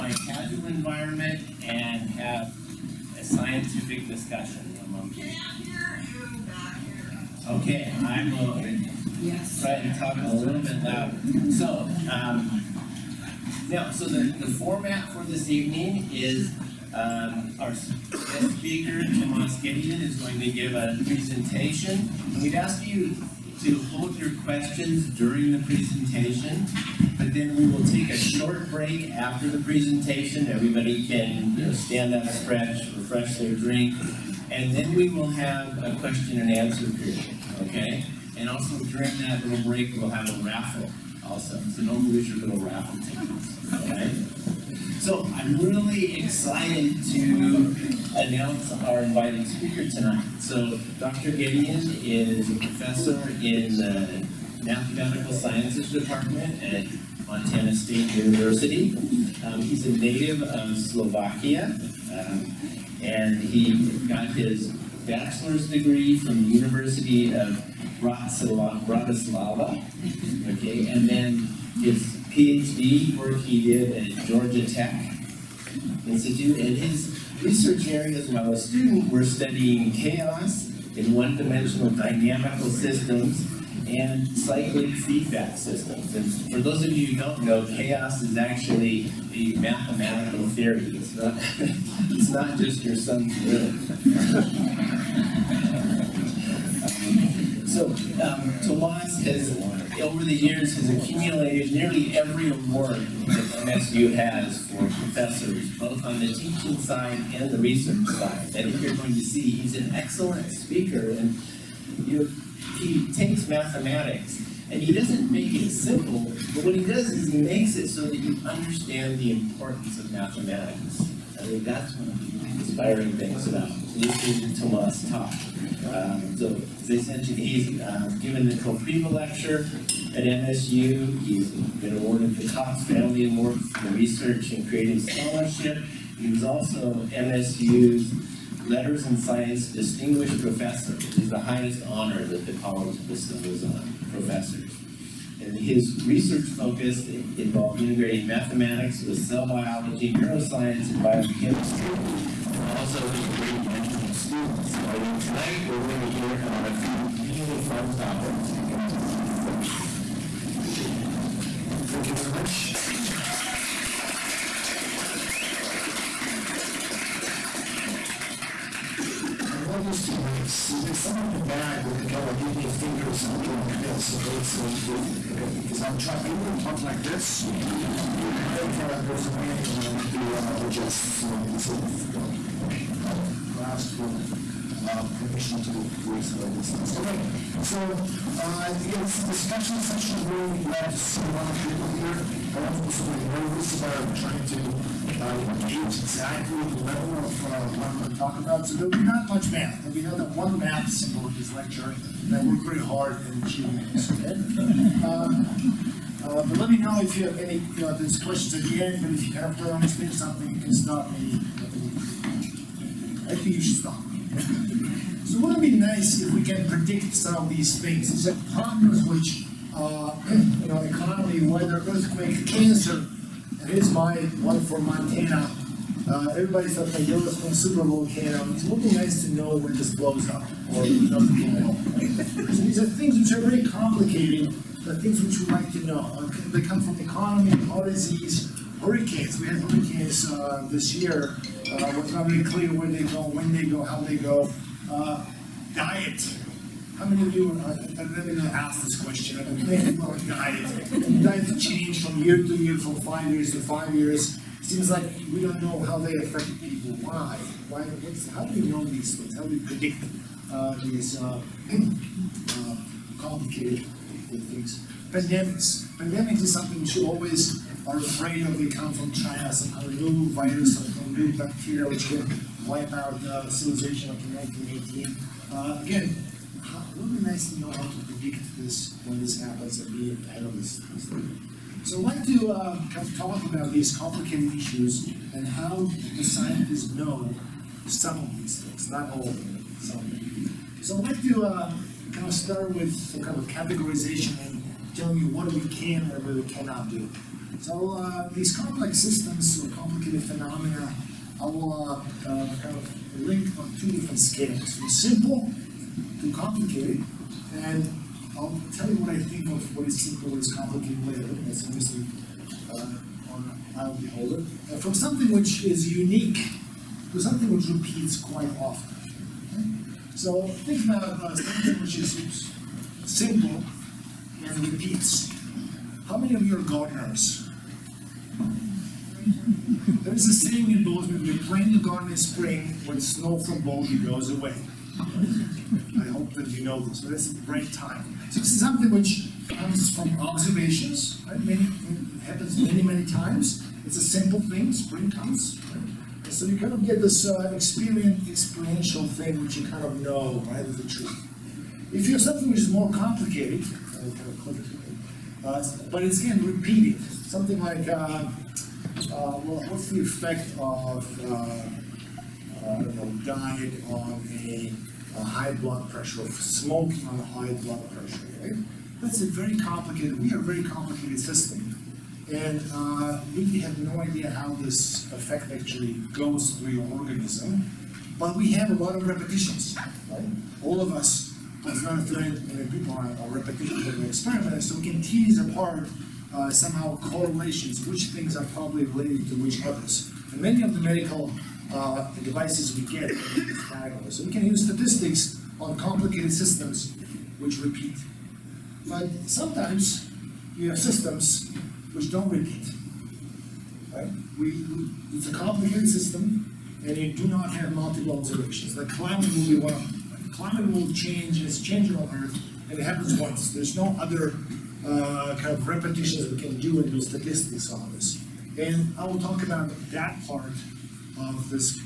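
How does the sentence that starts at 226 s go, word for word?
Uh, everybody thought that Yo from Super Volcano.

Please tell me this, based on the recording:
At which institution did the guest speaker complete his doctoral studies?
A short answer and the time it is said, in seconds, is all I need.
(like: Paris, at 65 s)
Georgia Tech, at 74 s.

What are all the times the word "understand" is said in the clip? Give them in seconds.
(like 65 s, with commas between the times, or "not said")
118 s, 209 s.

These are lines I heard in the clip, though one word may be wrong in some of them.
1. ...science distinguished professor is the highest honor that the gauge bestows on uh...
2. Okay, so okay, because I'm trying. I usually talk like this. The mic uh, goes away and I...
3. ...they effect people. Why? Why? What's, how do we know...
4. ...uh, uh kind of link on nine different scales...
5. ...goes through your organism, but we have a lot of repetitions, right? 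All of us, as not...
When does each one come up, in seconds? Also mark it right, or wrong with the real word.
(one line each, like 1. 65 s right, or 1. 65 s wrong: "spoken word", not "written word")
1. 139 s wrong: "college", not "gauge"
2. 174 s right
3. 255 s wrong: "affect", not "effect"
4. 301 s wrong: "two", not "nine"
5. 376 s right.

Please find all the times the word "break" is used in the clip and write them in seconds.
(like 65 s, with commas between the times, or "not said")
28 s, 39 s.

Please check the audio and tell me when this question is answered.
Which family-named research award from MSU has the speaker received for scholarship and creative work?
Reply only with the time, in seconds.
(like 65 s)
132 s.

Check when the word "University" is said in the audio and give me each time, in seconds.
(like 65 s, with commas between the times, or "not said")
58 s, 66 s.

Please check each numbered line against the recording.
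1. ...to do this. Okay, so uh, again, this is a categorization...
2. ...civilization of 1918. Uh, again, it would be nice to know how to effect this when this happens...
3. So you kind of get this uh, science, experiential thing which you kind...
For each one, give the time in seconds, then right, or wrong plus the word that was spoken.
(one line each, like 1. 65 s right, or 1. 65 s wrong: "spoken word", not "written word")
1. 185 s wrong: "discussion", not "categorization"
2. 273 s wrong: "predict", not "effect"
3. 346 s wrong: "experience", not "science".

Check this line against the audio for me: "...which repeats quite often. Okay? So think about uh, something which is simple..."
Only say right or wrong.
right.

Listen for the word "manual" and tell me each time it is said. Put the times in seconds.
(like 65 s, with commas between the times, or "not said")
not said.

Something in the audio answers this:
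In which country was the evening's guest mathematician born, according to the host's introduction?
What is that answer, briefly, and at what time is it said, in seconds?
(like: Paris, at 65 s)
Slovakia, at 60 s.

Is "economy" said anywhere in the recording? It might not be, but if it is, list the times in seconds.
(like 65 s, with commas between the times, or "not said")
220 s, 236 s.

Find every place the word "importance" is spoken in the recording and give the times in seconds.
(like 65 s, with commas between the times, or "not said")
119 s.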